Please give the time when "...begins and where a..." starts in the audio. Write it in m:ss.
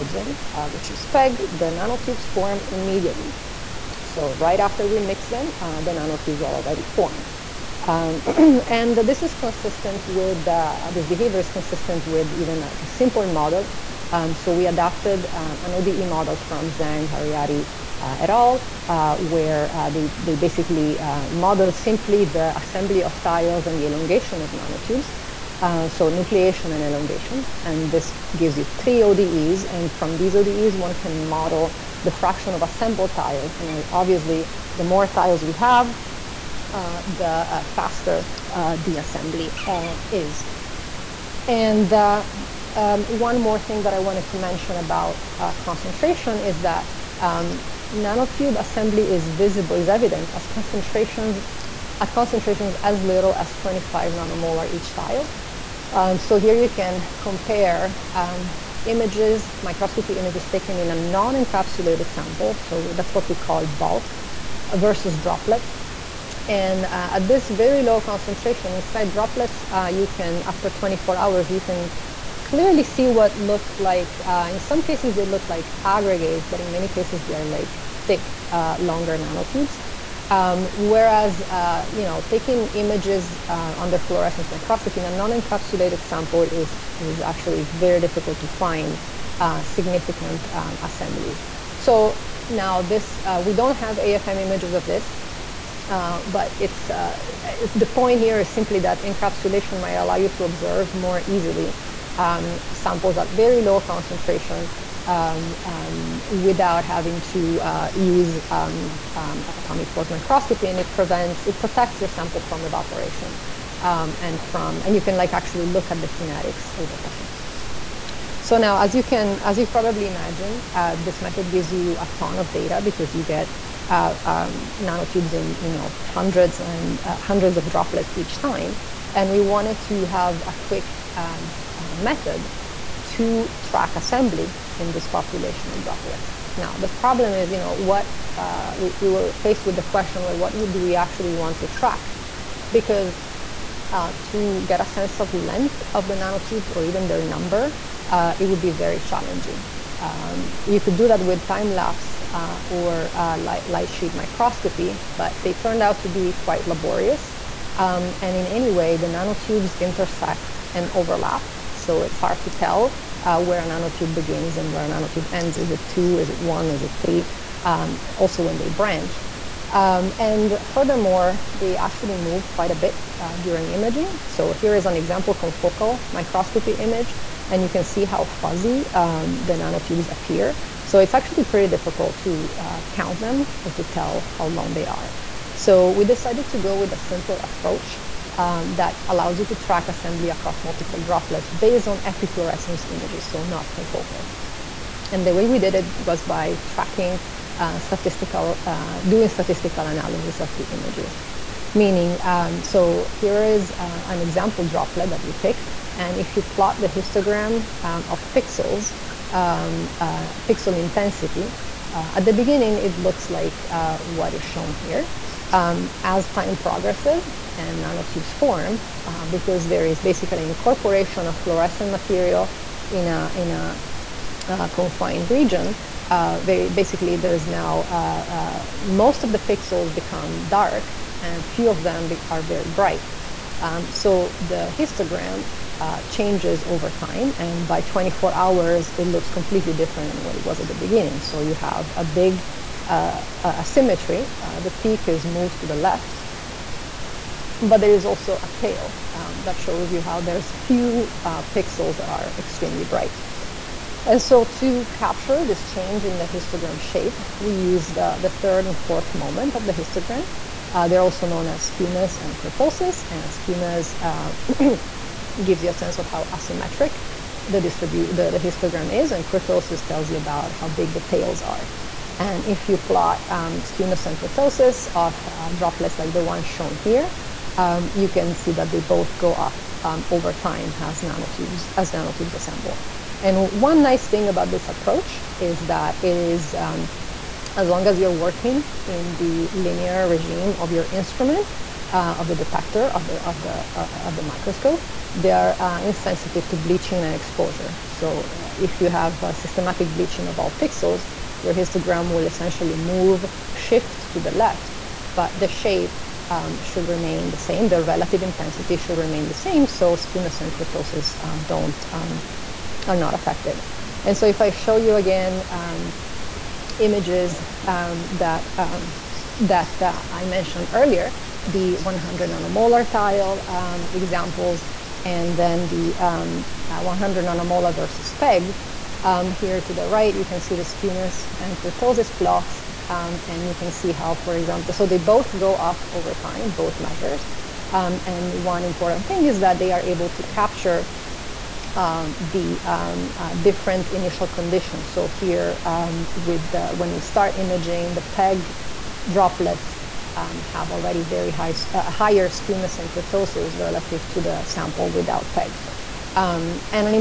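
2:44.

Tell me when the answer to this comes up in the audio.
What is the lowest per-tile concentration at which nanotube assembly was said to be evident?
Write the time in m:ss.
0:53.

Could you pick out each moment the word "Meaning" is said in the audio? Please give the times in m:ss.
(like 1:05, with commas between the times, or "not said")
3:21.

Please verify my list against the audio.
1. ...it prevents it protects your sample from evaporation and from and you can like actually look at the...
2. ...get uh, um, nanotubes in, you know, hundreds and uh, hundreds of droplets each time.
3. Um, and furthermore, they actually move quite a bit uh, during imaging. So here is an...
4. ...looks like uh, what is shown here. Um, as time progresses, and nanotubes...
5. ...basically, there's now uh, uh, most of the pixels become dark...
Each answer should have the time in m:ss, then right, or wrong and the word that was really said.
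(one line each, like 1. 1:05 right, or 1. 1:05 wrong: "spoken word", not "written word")
1. 1:50 right
2. 2:03 right
3. 2:49 right
4. 3:32 right
5. 3:46 right.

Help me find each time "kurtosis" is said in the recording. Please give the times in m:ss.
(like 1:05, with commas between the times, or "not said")
4:22, 4:29, 4:34, 5:10, 5:31, 5:52.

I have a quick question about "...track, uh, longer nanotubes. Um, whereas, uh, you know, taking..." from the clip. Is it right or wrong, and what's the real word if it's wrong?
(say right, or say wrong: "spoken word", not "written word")
wrong: "thick", not "track".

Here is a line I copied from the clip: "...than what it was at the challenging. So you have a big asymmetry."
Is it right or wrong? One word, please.
wrong.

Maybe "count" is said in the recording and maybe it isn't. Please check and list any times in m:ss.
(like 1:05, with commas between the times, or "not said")
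3:02.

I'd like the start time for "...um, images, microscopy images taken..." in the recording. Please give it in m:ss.
0:58.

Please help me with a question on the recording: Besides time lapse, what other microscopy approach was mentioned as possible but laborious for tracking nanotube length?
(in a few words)
light sheet microscopy.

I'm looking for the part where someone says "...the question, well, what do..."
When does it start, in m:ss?
2:19.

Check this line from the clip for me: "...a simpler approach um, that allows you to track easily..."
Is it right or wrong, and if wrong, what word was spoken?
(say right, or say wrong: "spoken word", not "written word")
wrong: "assembly", not "easily".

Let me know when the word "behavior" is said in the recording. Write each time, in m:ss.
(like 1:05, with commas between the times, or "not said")
0:11.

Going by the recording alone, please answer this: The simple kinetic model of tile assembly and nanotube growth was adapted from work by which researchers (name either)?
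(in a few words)
Zhang, Hariadi.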